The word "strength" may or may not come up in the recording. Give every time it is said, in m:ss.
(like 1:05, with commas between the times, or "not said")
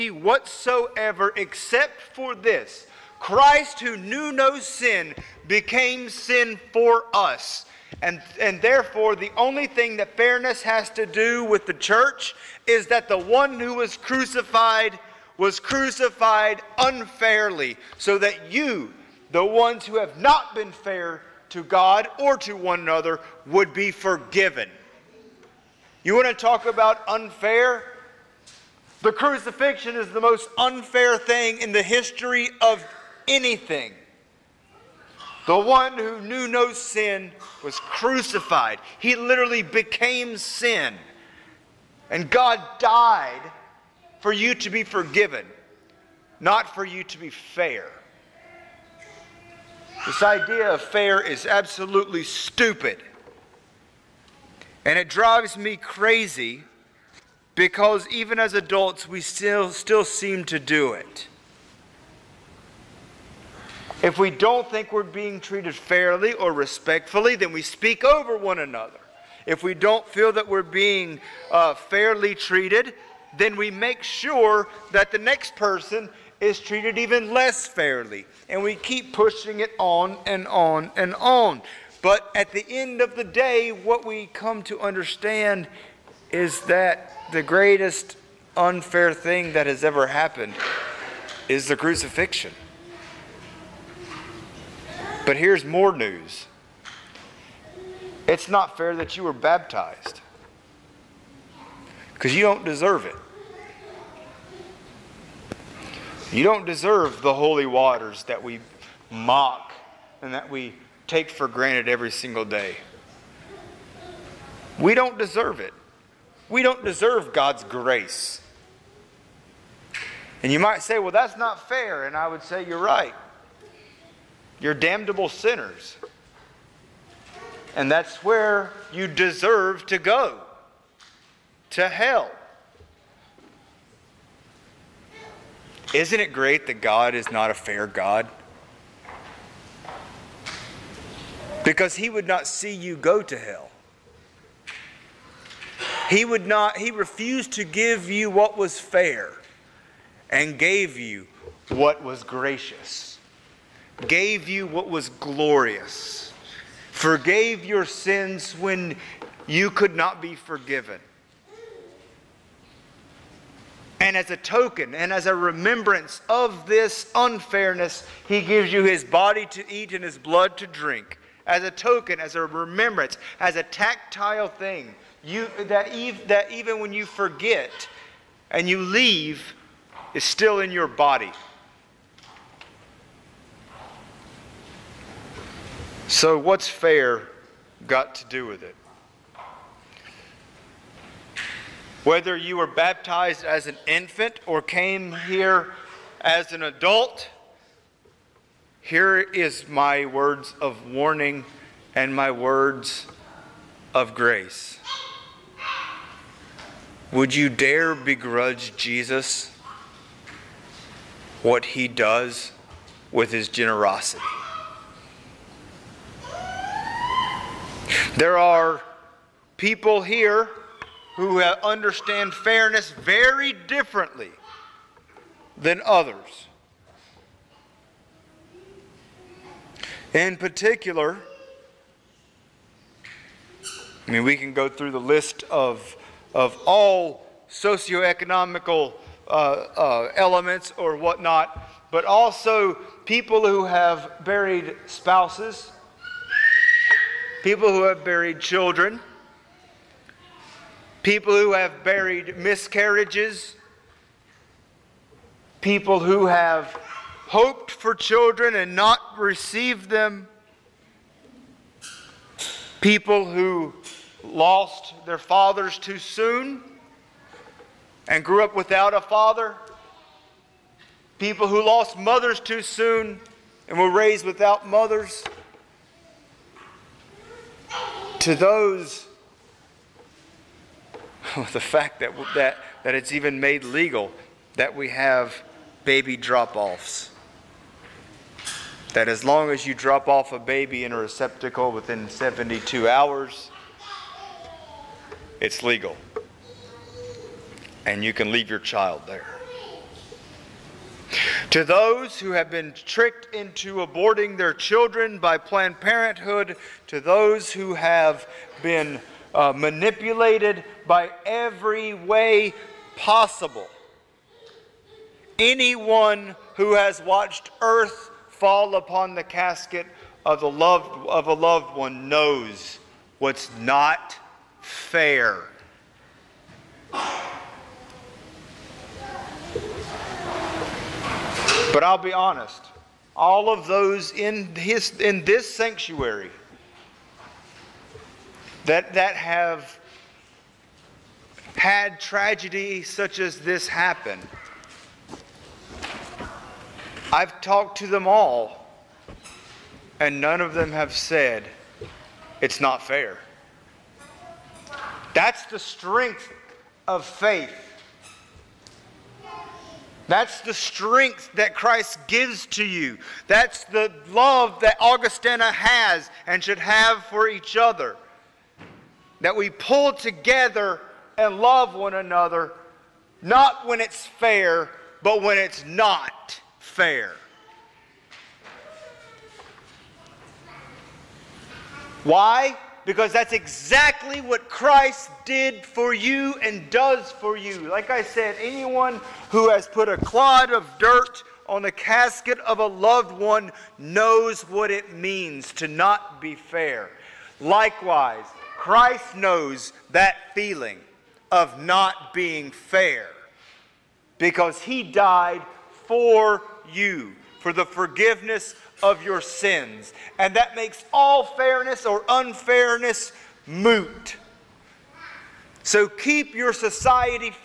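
5:55, 6:00.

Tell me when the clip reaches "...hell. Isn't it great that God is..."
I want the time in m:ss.
2:11.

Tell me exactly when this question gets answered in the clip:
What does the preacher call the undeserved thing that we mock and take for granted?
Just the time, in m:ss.
1:47.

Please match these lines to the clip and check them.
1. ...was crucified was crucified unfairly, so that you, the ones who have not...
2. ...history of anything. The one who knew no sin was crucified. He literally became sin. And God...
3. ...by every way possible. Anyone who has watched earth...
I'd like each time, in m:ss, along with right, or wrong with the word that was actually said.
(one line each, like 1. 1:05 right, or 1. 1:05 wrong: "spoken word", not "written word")
1. 0:13 right
2. 0:31 right
3. 5:10 right.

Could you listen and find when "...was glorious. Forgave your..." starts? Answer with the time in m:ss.
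2:34.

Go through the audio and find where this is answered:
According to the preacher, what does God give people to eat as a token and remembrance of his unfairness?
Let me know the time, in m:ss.
2:48.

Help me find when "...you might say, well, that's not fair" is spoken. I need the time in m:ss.
2:00.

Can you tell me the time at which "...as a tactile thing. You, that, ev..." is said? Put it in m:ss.
2:53.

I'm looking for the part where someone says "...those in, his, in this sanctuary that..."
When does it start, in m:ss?
5:33.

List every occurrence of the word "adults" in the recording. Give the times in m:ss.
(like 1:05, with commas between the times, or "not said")
0:58, 3:16.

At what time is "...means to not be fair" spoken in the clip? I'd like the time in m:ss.
6:34.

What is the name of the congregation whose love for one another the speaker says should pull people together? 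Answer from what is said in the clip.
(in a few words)
Augustana.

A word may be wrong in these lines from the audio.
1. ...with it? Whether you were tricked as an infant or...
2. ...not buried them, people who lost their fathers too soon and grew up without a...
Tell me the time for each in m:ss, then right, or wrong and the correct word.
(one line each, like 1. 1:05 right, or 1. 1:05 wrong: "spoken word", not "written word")
1. 3:08 wrong: "baptized", not "tricked"
2. 4:18 wrong: "received", not "buried".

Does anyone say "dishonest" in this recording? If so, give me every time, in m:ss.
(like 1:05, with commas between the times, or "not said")
not said.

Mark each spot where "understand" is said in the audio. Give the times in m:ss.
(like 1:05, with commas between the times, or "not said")
1:24, 3:41.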